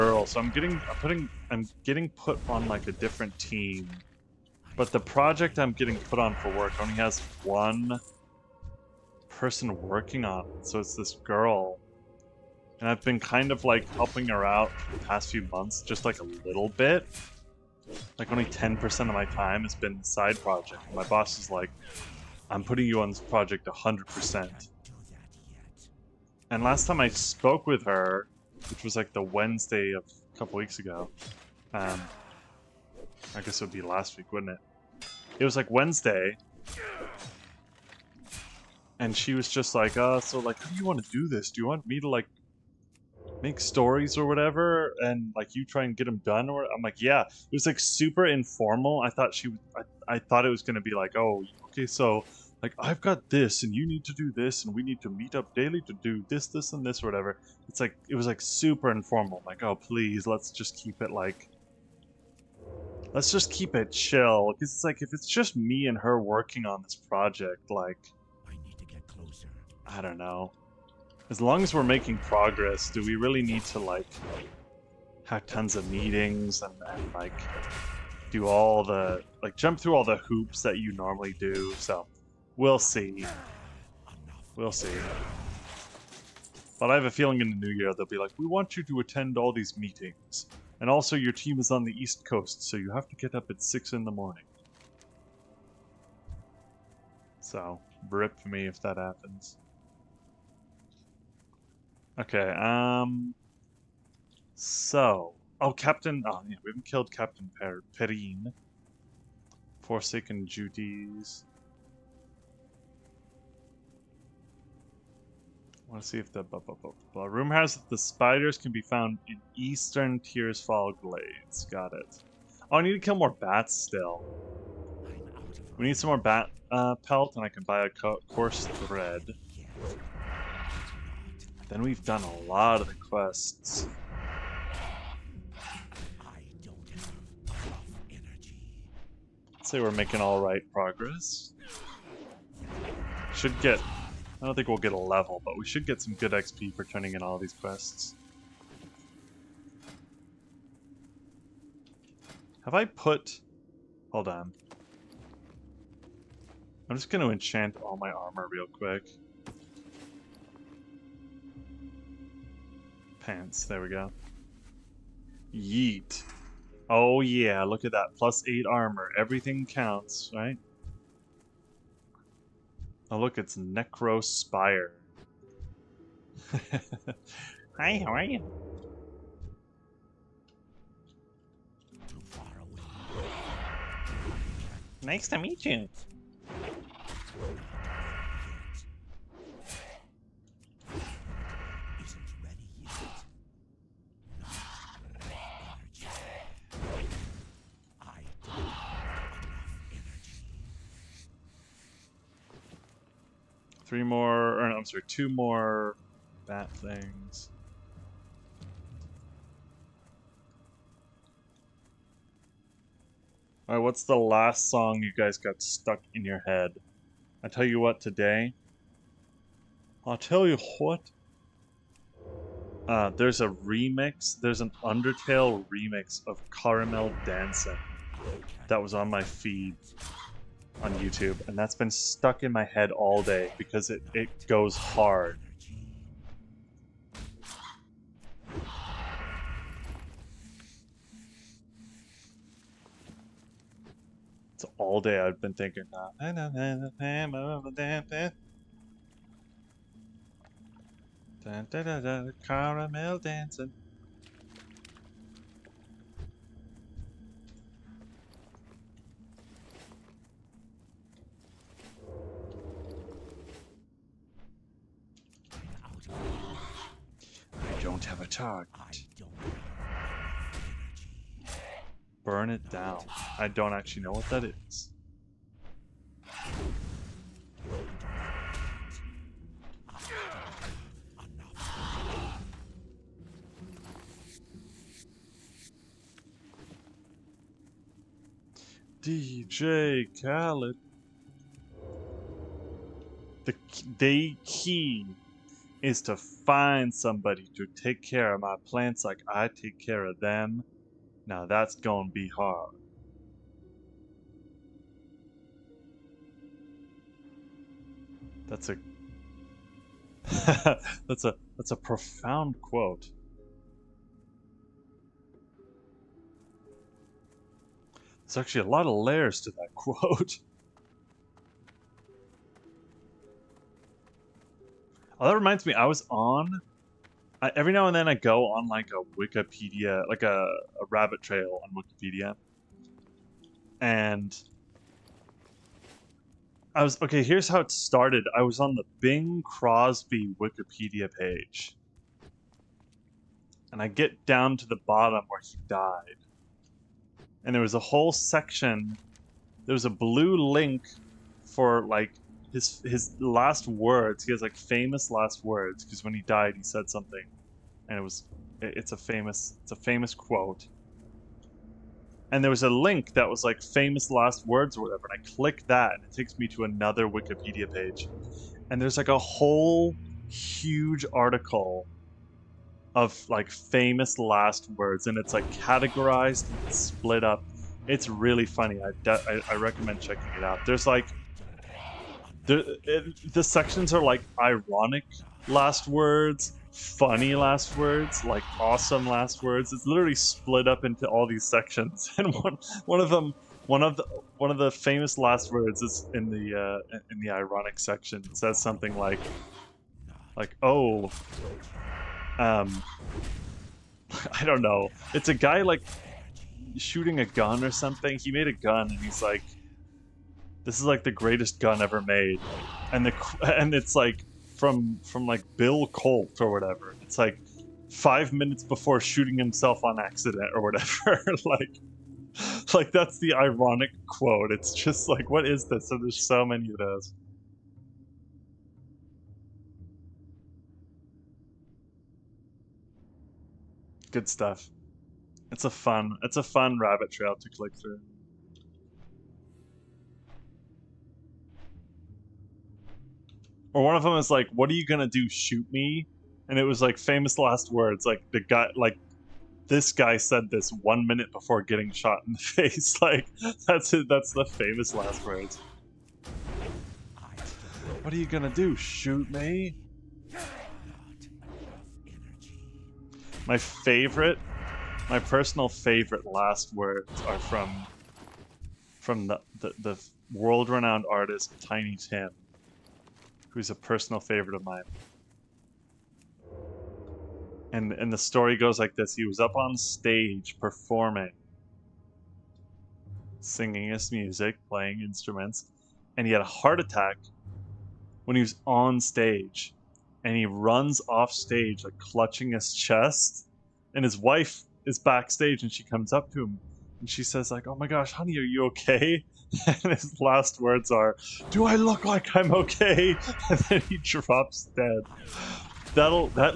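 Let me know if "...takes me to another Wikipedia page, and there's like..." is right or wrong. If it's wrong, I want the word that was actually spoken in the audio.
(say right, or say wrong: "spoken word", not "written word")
right.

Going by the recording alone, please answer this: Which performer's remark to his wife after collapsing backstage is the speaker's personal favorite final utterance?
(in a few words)
Tiny Tim.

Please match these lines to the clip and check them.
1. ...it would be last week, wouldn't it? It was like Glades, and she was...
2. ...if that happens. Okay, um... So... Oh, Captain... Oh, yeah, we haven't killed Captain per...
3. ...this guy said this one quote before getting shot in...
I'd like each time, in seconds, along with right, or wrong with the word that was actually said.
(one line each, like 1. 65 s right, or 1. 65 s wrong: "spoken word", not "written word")
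1. 33 s wrong: "Wednesday", not "Glades"
2. 98 s right
3. 449 s wrong: "minute", not "quote".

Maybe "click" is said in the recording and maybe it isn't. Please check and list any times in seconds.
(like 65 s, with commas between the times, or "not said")
365 s, 437 s.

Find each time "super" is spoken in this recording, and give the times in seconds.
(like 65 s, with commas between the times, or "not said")
47 s, 58 s.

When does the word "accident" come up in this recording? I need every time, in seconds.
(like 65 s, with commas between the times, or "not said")
420 s.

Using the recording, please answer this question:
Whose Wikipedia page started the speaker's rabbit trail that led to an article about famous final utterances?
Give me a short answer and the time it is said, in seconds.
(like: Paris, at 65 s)
Bing Crosby, at 339 s.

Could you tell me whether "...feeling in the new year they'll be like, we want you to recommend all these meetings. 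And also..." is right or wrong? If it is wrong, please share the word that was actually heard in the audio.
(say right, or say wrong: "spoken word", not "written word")
wrong: "attend", not "recommend".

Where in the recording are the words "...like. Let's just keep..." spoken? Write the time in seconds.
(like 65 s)
61 s.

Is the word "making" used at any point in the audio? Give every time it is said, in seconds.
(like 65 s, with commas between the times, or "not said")
71 s, 139 s.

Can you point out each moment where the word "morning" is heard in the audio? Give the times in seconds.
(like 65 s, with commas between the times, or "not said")
94 s.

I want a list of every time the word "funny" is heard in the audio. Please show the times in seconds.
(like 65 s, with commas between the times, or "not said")
378 s, 386 s.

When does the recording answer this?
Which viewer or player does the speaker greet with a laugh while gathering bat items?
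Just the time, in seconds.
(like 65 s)
173 s.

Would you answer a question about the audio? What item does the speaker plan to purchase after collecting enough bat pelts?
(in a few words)
Coarse thread.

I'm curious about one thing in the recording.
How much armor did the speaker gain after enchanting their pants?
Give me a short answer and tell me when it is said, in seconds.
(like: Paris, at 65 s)
8, at 168 s.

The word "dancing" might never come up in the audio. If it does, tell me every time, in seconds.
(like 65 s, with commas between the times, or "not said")
227 s, 253 s.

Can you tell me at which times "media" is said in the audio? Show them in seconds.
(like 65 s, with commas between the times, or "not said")
not said.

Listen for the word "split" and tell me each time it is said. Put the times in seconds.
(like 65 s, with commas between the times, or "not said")
376 s, 390 s.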